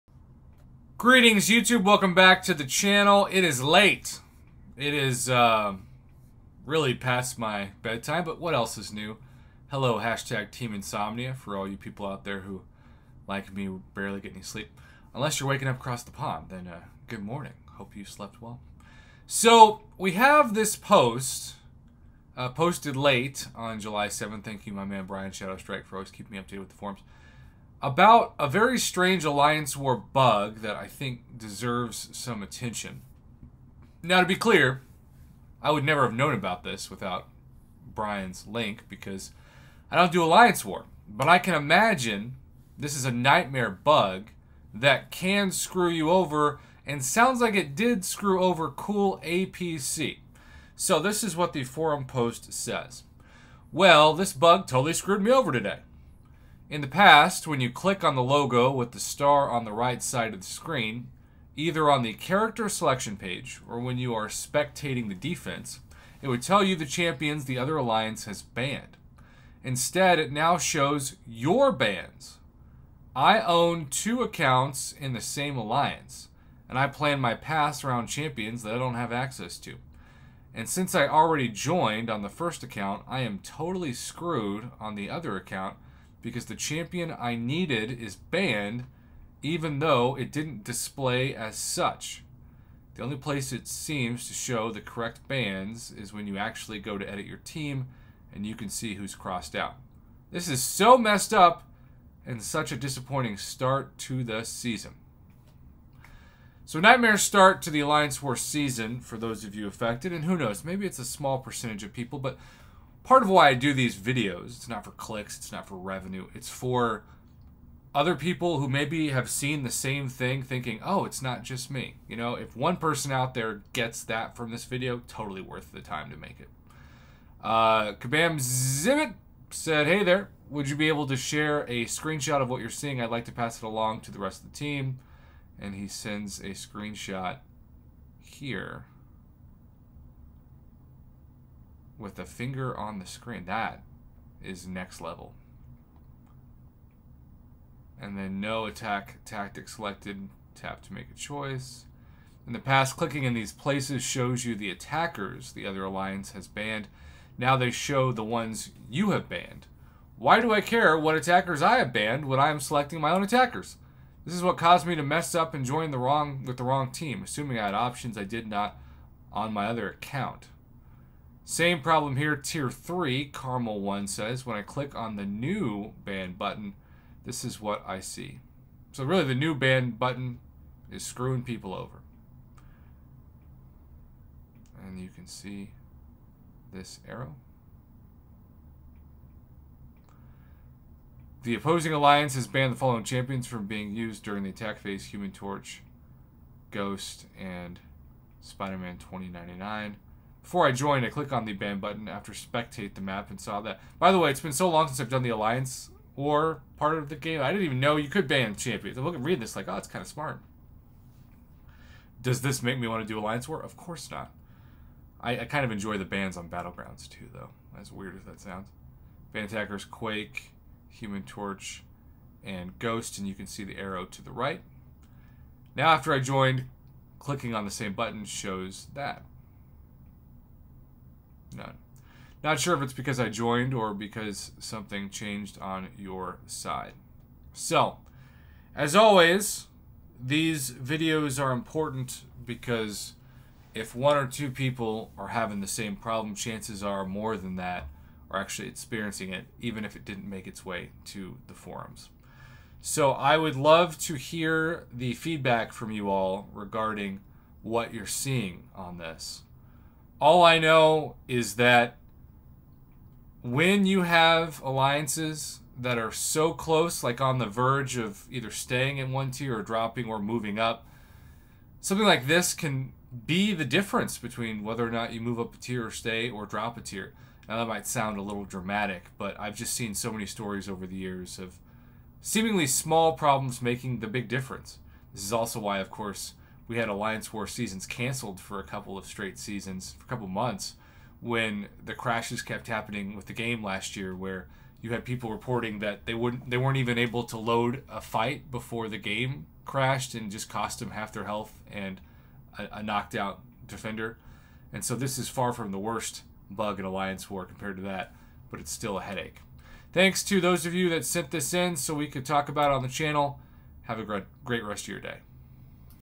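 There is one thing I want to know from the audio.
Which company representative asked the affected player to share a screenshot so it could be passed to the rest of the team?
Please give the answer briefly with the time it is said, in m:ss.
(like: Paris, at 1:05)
Kabam Zibiit, at 2:07.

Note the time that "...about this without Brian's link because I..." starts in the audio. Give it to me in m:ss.
0:36.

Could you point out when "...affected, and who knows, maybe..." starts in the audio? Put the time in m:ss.
1:49.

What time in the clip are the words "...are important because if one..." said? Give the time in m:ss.
4:01.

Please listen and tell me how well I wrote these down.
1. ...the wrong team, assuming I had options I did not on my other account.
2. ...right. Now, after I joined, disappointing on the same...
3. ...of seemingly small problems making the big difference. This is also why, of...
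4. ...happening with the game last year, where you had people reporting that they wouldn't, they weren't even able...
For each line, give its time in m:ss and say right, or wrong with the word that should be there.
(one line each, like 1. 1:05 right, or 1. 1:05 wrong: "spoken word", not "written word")
1. 2:46 right
2. 3:44 wrong: "clicking", not "disappointing"
3. 4:41 right
4. 4:52 right.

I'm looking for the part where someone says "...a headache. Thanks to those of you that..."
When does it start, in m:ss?
5:08.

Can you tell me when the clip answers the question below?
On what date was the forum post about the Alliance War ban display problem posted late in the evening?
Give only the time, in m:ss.
0:23.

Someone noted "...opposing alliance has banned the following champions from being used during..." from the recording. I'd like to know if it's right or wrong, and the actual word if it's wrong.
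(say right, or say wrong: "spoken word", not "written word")
right.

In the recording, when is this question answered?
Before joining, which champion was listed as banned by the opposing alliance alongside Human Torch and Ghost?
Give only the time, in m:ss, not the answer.
3:18.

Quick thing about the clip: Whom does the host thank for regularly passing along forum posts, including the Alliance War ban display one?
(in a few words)
Brian Shadowstrike.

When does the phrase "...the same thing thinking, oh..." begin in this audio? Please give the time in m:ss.
1:59.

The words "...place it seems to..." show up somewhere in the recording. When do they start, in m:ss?
1:33.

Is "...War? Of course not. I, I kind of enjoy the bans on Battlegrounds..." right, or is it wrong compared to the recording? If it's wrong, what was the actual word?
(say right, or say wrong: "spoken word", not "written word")
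right.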